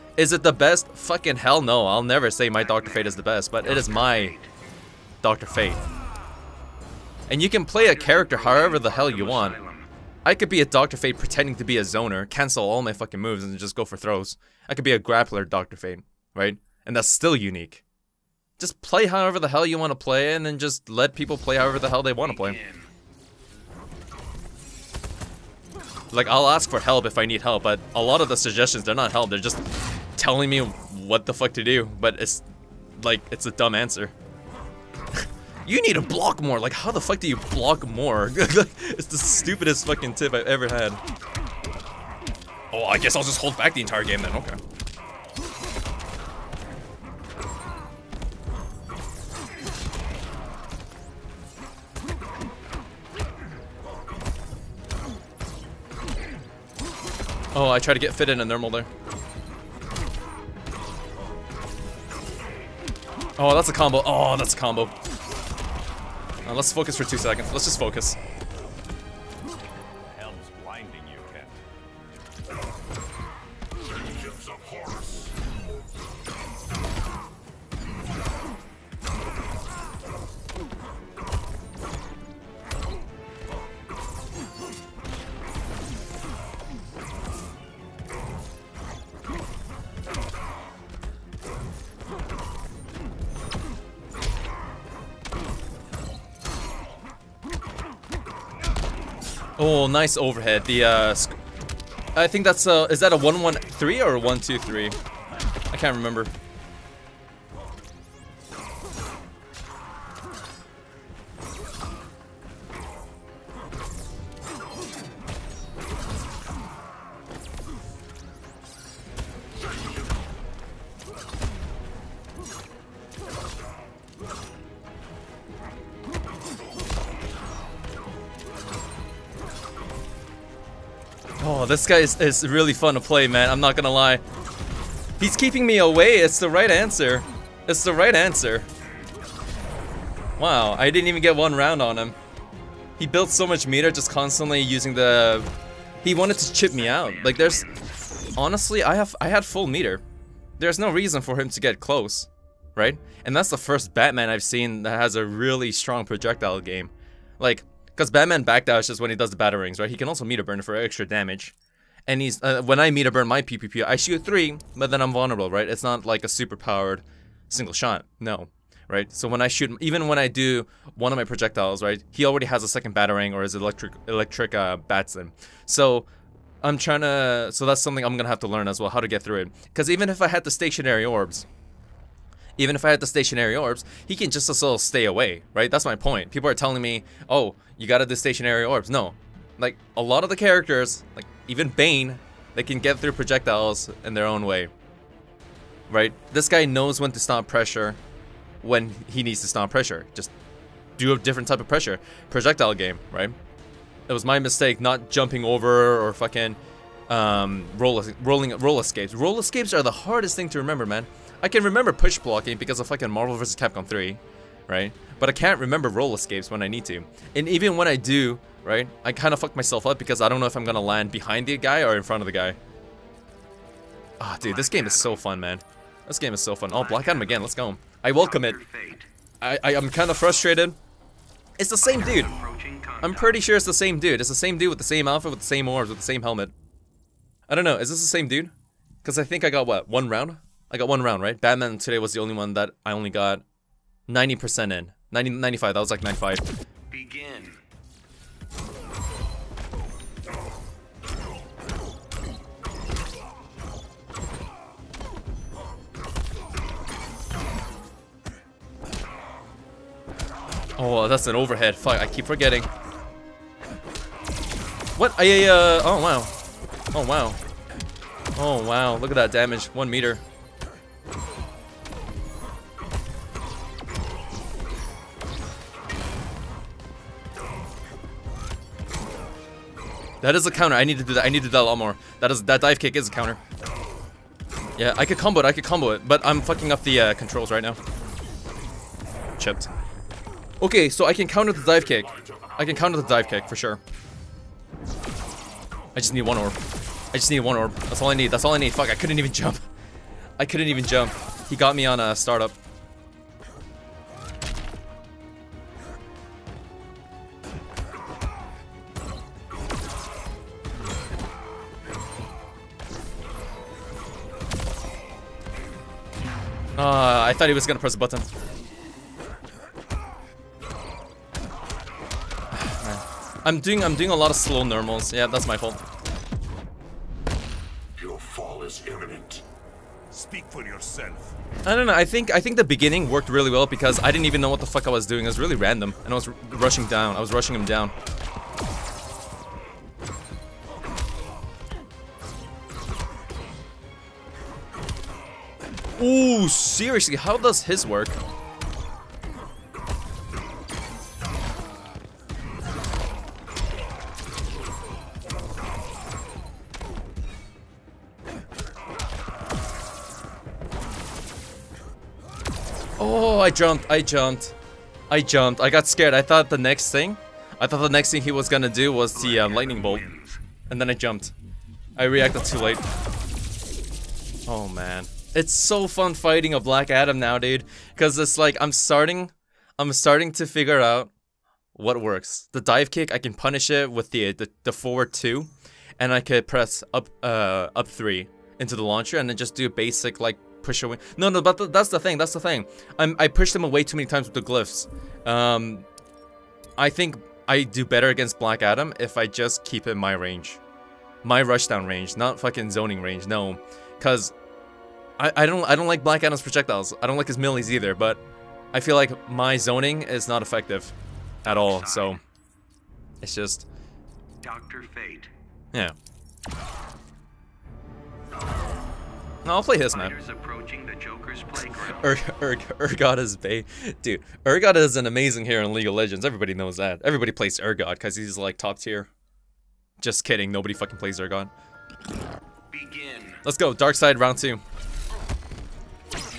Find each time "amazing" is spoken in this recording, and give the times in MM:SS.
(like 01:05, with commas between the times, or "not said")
07:05.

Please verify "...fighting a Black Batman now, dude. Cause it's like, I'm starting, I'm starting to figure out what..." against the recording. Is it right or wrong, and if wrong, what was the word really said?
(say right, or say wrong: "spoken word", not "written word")
wrong: "Adam", not "Batman".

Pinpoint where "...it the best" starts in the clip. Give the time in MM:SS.
00:00.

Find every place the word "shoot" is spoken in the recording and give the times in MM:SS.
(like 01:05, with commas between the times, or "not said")
02:43, 02:49.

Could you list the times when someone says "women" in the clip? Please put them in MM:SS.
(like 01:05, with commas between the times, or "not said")
not said.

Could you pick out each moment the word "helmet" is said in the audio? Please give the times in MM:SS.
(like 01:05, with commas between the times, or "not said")
03:56.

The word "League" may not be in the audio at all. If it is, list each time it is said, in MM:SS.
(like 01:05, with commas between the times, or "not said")
07:05.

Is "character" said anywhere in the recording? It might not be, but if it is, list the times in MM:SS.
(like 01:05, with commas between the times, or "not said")
00:07, 03:10.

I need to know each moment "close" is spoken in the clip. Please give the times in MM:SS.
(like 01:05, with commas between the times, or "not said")
02:31.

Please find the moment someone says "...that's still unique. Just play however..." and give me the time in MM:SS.
00:16.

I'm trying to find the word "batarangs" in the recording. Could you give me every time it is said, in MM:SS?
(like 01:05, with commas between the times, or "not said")
02:39, 02:52.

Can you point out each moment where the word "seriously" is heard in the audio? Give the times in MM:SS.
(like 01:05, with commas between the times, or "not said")
05:46.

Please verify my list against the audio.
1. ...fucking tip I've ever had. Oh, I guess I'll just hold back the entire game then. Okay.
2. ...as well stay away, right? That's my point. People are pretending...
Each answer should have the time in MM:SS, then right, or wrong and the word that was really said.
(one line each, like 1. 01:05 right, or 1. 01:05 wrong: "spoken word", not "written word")
1. 00:39 right
2. 03:04 wrong: "telling", not "pretending".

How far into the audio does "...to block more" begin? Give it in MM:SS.
00:35.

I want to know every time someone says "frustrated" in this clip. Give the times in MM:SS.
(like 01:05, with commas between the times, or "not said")
03:50.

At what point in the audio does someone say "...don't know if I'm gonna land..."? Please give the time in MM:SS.
03:40.